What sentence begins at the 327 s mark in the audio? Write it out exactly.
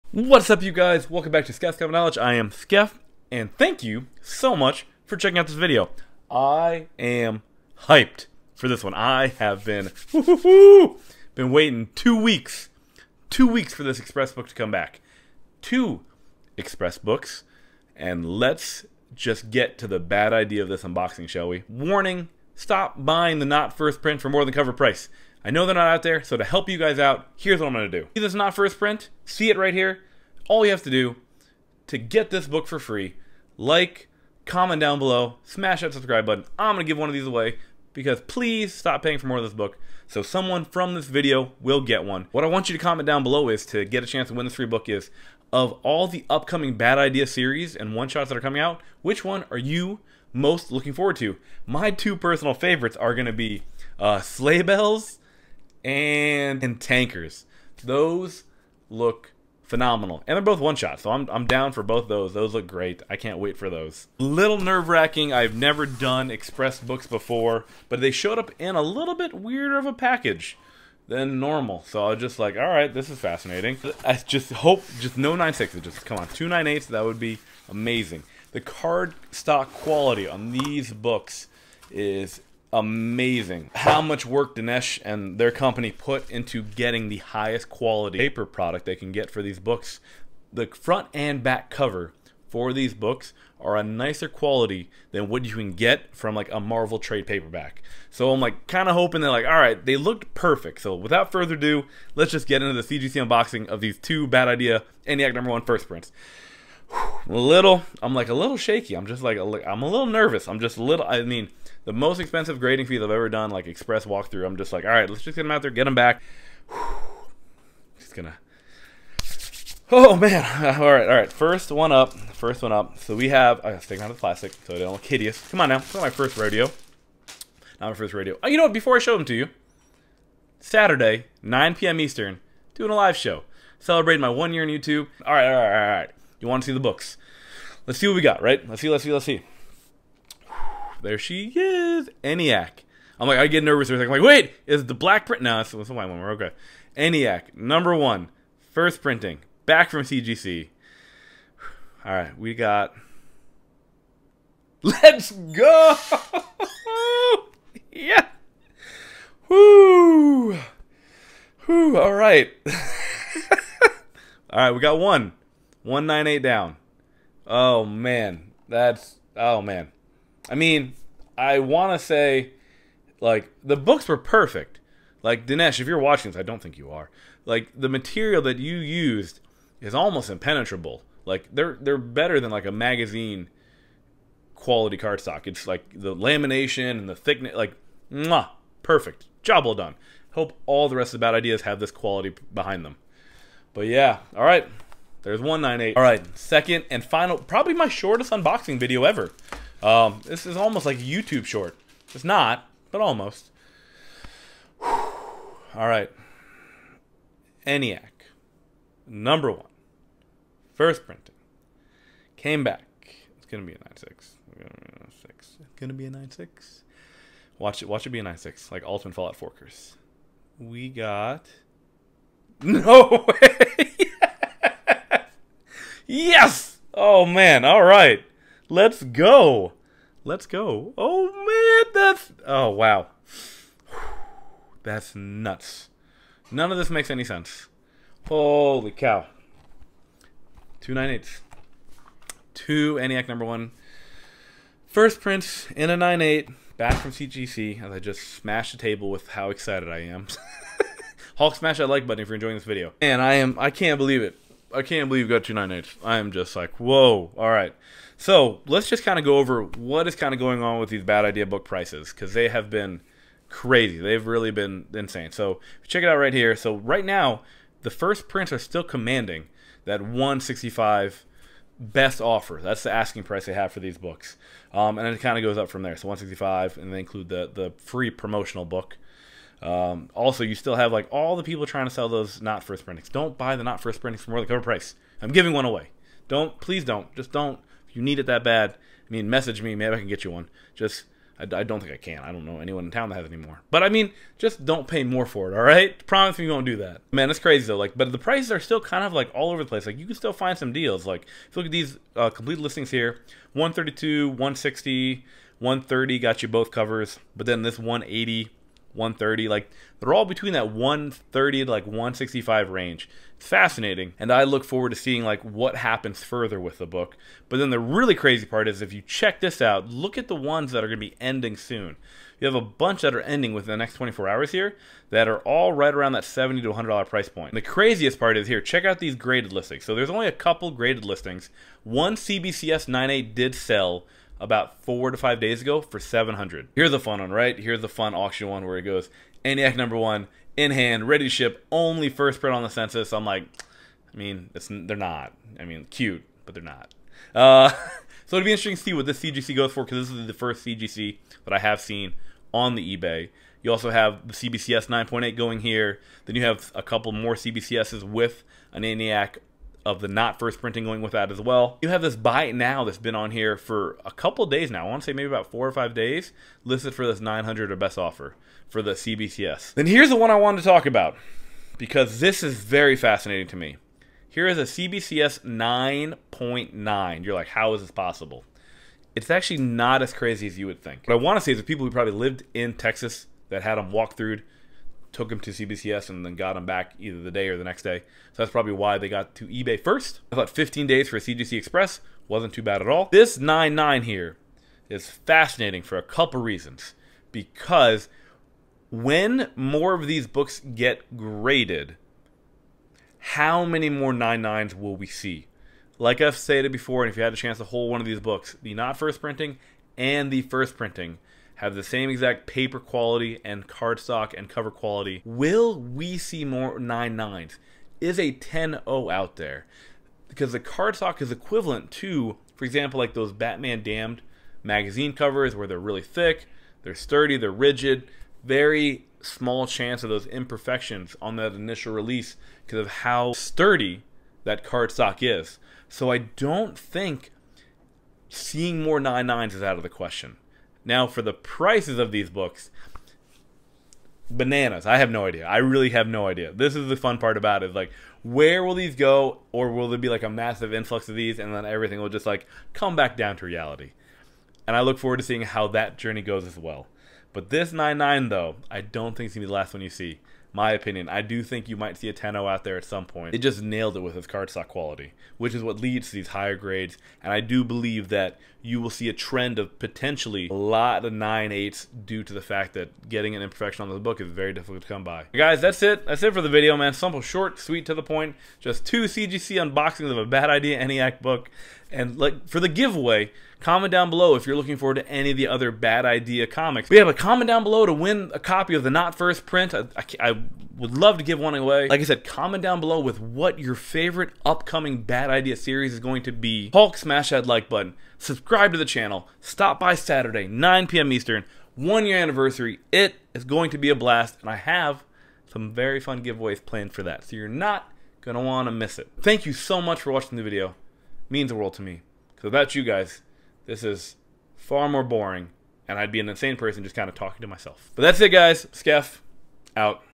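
And the craziest part is here.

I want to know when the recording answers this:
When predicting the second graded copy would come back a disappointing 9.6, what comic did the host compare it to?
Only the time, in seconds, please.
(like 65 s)
218 s.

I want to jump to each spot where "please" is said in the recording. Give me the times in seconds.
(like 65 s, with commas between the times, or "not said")
38 s, 286 s.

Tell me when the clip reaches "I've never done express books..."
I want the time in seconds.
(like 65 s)
65 s.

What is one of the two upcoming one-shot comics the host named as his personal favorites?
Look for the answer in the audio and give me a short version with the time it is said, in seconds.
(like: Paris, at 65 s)
Sleigh Bells, at 54 s.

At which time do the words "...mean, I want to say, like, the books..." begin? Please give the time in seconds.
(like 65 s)
170 s.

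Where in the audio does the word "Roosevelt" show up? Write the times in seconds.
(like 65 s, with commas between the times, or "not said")
not said.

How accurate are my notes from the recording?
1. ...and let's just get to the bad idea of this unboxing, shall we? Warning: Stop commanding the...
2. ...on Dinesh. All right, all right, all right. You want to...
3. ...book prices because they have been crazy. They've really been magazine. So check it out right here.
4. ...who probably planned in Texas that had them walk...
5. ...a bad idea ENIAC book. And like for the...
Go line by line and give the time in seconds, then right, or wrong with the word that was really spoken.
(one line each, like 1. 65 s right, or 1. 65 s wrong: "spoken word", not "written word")
1. 17 s wrong: "buying", not "commanding"
2. 134 s wrong: "YouTube", not "Dinesh"
3. 261 s wrong: "insane", not "magazine"
4. 381 s wrong: "lived", not "planned"
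5. 480 s right.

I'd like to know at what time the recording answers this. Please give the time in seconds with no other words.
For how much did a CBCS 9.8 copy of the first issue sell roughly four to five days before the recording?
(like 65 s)
335 s.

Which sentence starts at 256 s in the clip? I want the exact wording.
I am just like, whoa, alright.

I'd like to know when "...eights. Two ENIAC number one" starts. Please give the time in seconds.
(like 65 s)
241 s.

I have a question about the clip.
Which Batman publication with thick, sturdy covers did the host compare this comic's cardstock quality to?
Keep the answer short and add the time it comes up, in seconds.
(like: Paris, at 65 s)
Batman Damned, at 423 s.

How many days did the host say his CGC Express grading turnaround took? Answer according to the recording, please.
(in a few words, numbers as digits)
15 days.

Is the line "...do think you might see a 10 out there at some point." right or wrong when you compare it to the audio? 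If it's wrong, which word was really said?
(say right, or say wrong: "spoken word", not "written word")
right.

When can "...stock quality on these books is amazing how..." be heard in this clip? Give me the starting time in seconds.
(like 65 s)
79 s.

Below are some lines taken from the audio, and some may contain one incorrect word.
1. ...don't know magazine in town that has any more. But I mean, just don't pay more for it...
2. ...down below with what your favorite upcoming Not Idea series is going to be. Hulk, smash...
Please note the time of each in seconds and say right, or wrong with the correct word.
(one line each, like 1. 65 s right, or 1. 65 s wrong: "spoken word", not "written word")
1. 292 s wrong: "anyone", not "magazine"
2. 492 s wrong: "Bad", not "Not".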